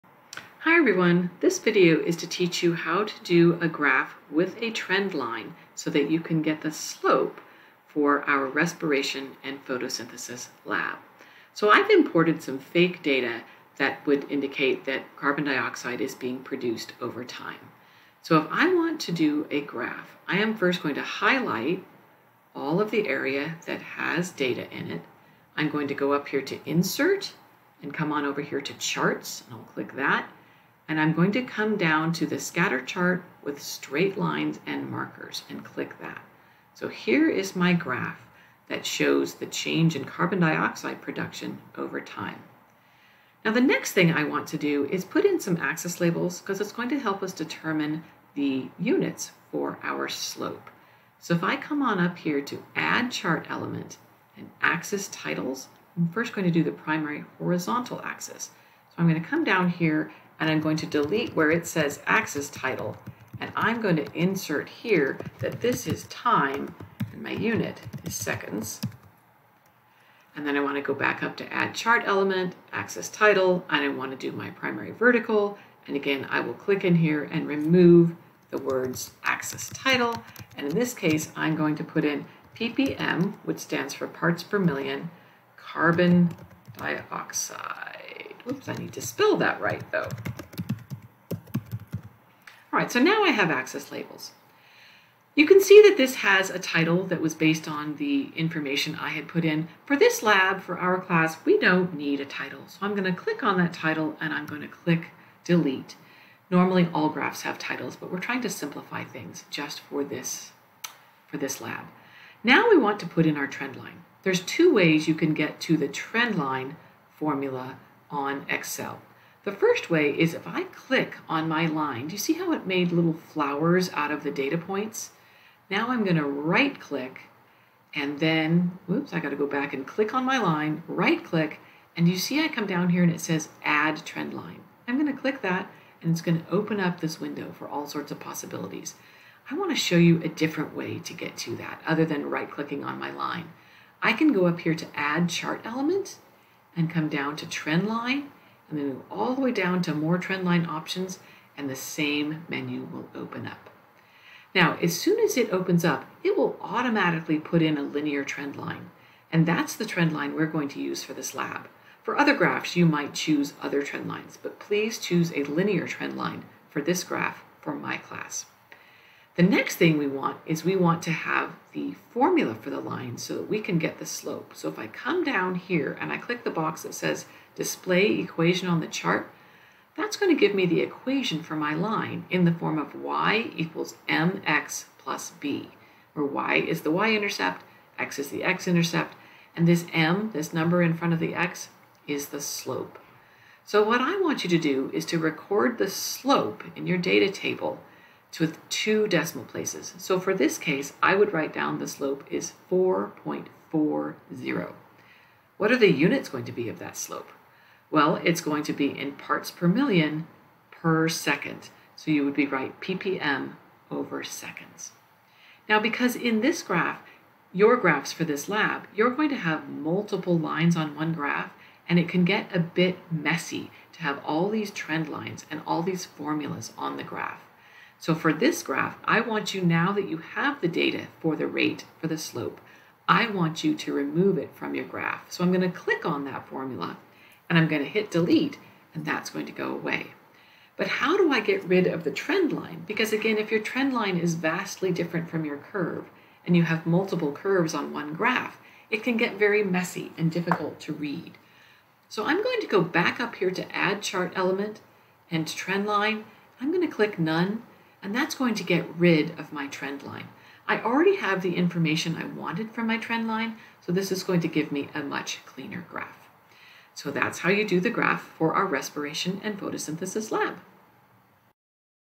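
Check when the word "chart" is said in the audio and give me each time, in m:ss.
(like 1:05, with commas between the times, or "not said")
0:28, 0:32, 0:53, 1:11, 2:25, 2:58, 4:14.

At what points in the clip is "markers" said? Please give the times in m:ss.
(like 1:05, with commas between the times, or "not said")
0:34.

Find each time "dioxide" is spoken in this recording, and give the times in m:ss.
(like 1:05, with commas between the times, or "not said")
0:15, 0:40, 1:26.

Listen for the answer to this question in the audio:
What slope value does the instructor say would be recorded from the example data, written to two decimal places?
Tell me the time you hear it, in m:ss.
3:22.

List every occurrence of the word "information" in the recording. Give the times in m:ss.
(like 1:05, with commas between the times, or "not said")
1:38, 4:21.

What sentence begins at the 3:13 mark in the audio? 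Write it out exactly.
So what I want you to do is to record the slope in your data table with two decimal places.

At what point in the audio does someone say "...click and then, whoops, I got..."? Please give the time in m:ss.
2:06.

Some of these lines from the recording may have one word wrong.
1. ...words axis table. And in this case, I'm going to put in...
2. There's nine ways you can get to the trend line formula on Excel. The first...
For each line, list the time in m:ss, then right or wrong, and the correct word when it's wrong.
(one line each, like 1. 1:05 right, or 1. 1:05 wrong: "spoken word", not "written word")
1. 1:18 wrong: "title", not "table"
2. 1:54 wrong: "two", not "nine".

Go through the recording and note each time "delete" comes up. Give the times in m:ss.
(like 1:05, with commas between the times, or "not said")
1:00, 1:45, 3:58.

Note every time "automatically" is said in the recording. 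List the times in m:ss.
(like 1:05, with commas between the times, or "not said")
2:36.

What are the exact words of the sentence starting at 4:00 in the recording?
But how do I get rid of the trend line?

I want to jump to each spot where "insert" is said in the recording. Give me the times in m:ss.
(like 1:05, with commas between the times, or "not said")
0:26, 1:04.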